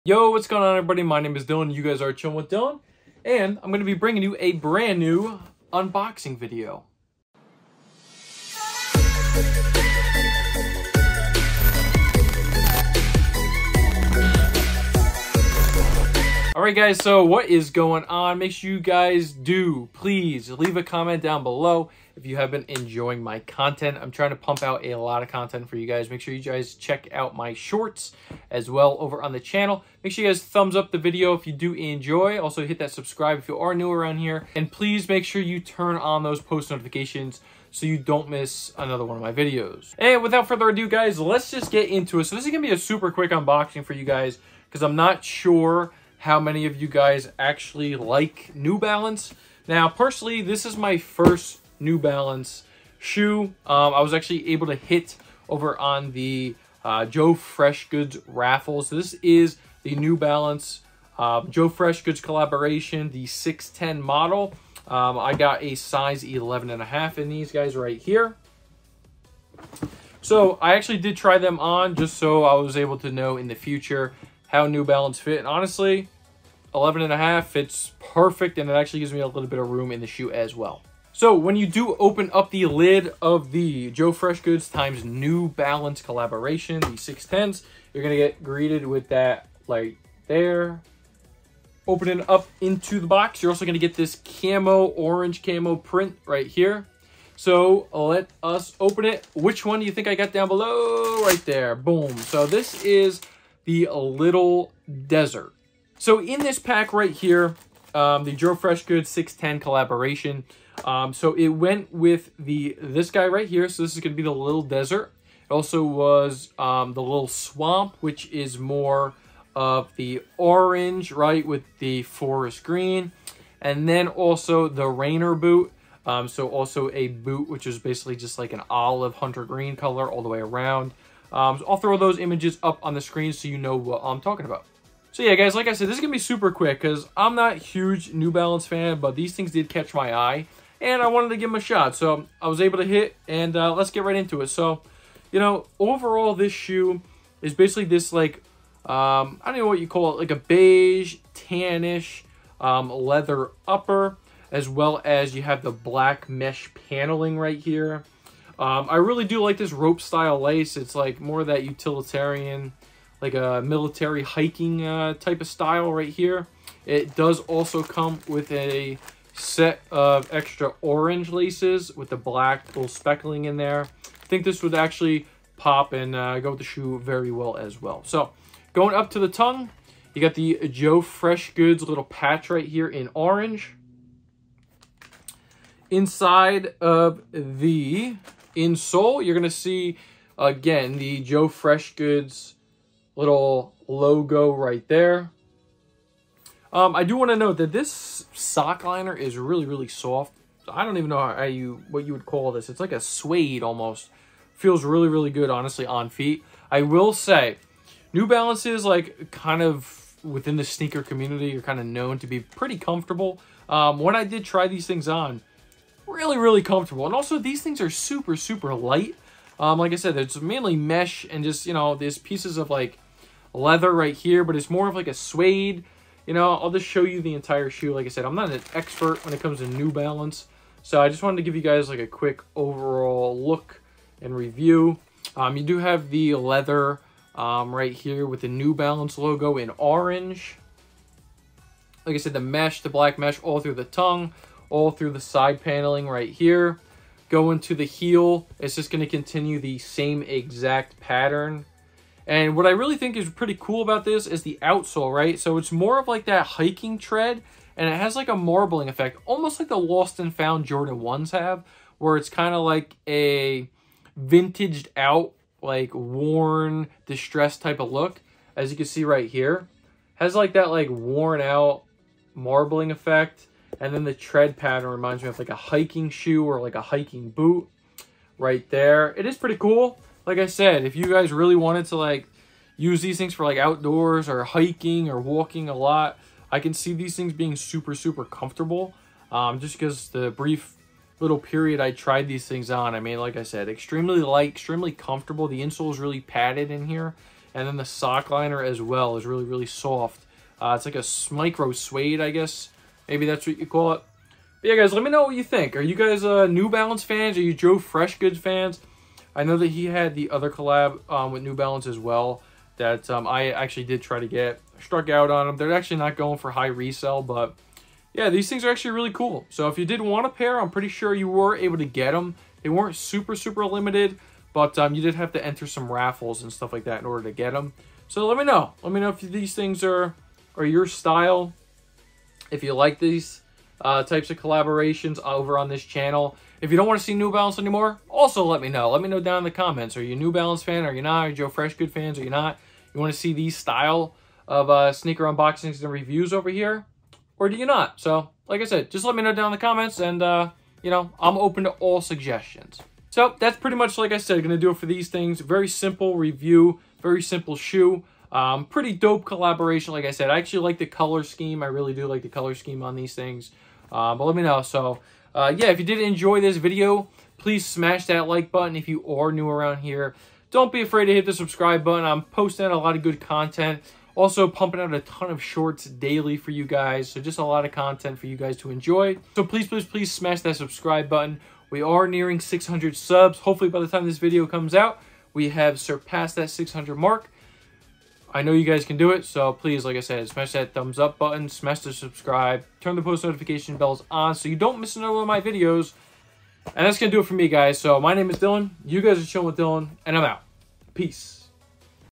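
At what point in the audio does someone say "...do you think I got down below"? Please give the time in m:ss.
1:39.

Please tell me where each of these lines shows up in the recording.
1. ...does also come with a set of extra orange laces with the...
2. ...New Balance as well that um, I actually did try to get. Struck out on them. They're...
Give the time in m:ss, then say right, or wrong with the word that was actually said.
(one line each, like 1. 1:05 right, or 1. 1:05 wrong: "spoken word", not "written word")
1. 2:47 right
2. 5:11 right.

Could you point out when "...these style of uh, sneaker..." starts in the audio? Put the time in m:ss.
5:43.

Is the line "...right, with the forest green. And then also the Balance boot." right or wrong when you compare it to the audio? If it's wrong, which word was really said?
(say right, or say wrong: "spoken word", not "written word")
wrong: "Rainer", not "Balance".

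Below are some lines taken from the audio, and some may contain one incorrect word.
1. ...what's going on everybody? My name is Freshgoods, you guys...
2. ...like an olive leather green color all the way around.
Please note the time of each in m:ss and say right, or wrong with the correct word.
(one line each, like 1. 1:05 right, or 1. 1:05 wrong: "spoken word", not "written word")
1. 0:00 wrong: "Dylan", not "Freshgoods"
2. 2:08 wrong: "hunter", not "leather".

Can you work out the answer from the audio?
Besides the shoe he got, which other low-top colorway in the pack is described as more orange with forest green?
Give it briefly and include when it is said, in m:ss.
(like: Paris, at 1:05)
Little Swamp, at 1:57.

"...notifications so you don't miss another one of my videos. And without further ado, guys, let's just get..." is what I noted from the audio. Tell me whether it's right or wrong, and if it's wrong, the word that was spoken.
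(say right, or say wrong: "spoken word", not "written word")
right.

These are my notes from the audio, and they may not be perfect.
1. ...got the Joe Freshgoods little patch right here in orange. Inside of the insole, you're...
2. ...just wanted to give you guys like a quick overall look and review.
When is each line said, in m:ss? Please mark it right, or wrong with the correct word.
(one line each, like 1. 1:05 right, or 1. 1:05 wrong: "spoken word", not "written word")
1. 3:00 right
2. 3:51 right.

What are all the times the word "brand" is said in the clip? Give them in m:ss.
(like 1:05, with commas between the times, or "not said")
0:04.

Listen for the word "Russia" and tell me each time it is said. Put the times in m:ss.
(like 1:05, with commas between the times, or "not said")
not said.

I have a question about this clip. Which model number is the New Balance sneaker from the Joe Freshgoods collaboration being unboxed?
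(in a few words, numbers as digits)
610.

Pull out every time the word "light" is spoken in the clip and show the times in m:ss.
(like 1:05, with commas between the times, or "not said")
3:38, 4:54.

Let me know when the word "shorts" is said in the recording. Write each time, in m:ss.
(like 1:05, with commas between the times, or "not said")
0:27, 6:15.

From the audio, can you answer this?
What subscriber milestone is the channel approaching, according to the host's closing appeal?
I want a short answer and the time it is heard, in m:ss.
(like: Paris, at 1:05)
600, at 6:22.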